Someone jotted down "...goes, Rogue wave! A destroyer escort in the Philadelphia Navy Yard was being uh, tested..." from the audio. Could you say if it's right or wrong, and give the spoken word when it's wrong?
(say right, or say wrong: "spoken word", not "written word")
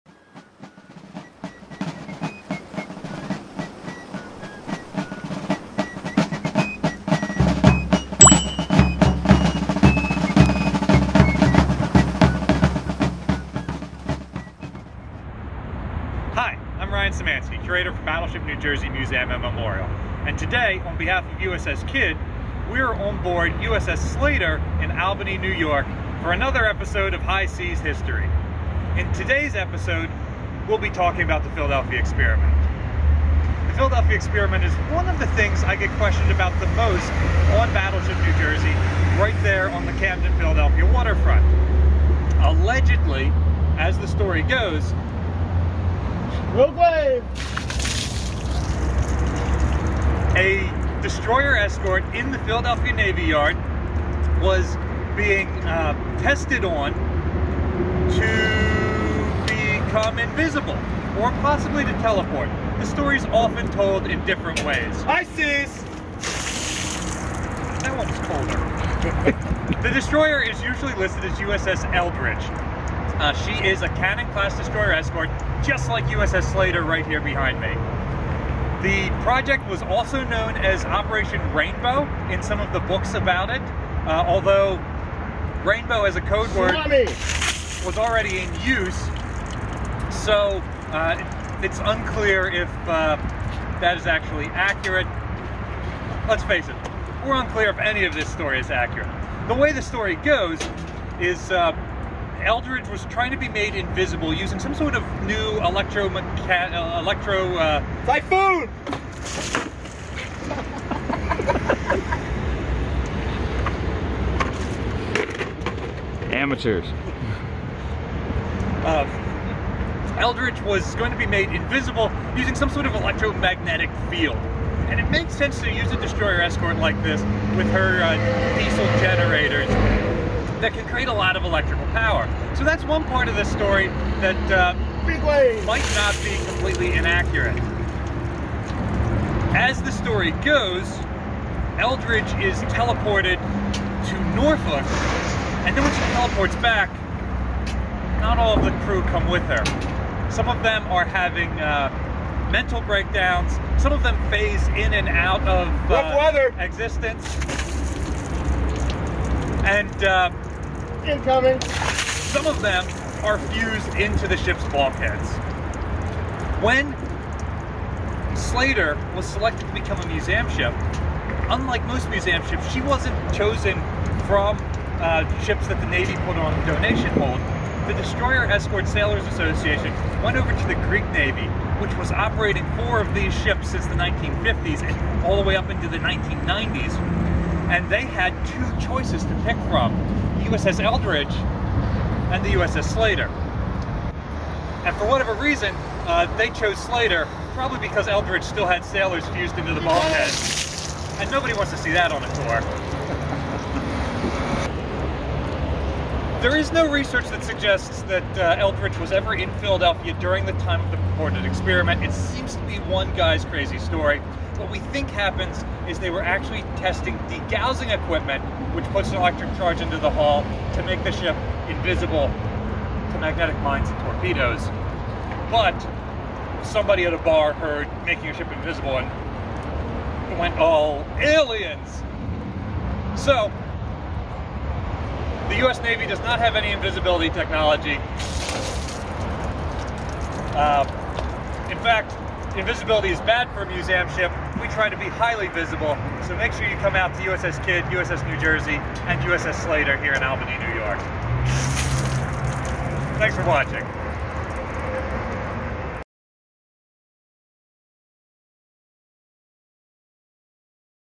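right.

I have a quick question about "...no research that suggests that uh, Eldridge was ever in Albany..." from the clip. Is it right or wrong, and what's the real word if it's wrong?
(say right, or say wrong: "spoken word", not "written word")
wrong: "Philadelphia", not "Albany".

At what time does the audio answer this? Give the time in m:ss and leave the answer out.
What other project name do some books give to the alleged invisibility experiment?
1:20.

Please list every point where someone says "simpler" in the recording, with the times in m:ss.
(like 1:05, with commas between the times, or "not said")
not said.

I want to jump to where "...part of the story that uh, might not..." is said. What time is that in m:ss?
2:13.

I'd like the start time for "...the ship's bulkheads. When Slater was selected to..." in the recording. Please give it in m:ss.
2:44.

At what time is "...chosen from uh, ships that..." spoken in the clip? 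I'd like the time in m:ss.
2:53.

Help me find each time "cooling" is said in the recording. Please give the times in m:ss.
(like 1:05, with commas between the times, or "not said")
not said.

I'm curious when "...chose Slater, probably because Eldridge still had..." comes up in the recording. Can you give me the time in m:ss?
3:16.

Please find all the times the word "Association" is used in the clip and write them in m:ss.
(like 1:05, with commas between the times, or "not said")
2:59.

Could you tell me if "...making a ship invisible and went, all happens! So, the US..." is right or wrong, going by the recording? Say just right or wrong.
wrong.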